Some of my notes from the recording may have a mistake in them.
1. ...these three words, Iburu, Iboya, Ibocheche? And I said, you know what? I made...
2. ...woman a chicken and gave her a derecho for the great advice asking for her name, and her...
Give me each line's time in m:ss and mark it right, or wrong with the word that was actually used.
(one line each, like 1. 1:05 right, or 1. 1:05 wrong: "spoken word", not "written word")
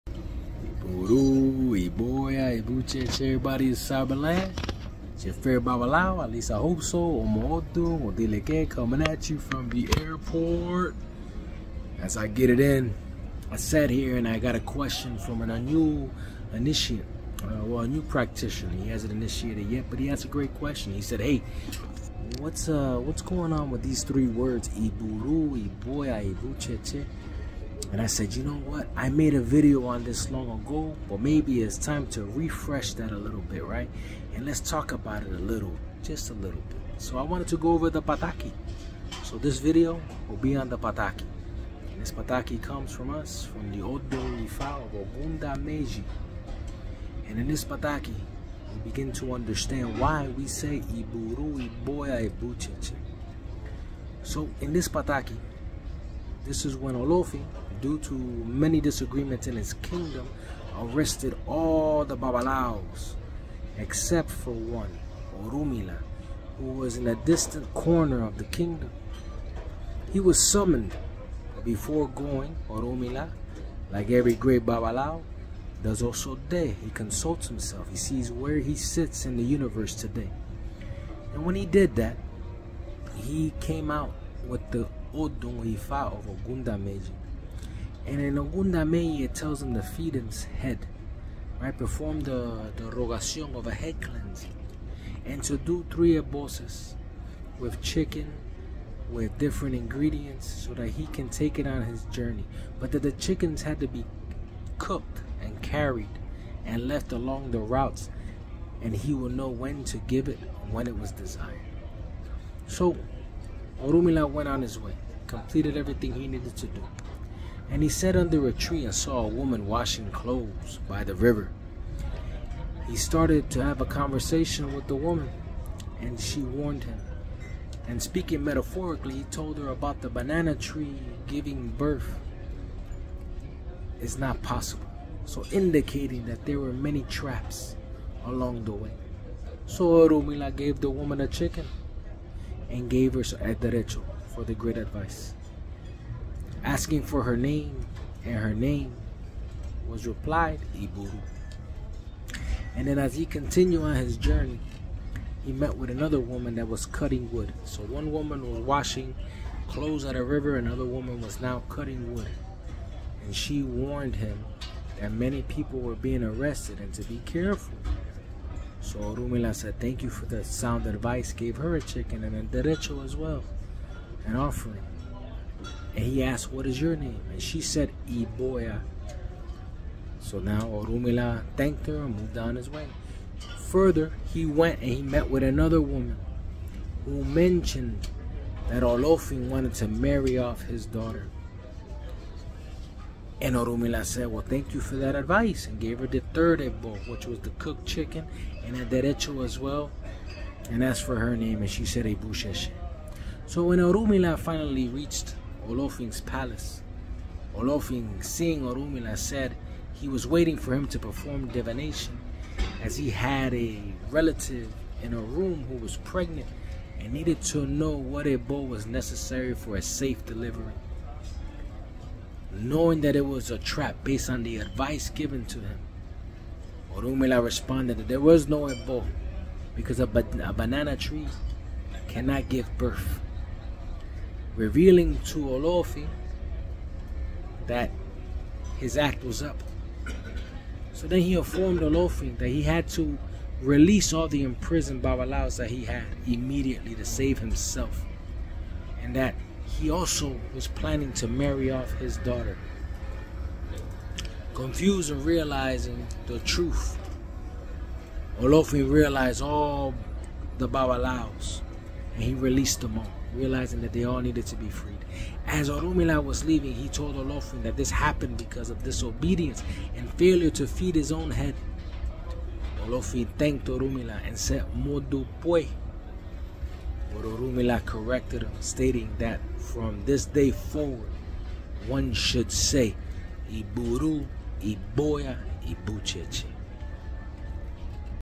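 1. 0:23 right
2. 2:20 right.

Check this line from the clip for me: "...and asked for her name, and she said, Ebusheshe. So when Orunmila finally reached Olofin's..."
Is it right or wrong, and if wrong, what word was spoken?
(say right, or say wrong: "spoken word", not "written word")
right.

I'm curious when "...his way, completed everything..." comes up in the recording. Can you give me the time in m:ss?
1:54.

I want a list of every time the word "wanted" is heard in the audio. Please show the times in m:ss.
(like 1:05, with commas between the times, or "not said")
0:37, 3:09.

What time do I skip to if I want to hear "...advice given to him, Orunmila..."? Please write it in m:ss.
3:44.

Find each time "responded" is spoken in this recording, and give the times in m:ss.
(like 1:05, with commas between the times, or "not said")
3:47.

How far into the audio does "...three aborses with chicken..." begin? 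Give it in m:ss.
1:35.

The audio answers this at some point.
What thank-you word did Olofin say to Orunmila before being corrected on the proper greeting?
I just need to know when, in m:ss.
4:34.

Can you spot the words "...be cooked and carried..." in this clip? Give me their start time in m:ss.
1:43.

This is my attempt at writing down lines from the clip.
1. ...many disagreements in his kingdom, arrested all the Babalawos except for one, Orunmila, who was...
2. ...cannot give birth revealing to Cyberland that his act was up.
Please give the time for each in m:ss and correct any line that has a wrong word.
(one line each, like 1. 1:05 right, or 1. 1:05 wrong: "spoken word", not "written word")
1. 0:58 right
2. 3:52 wrong: "Olofi", not "Cyberland".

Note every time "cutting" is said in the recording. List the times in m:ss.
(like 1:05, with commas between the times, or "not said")
2:36, 2:41.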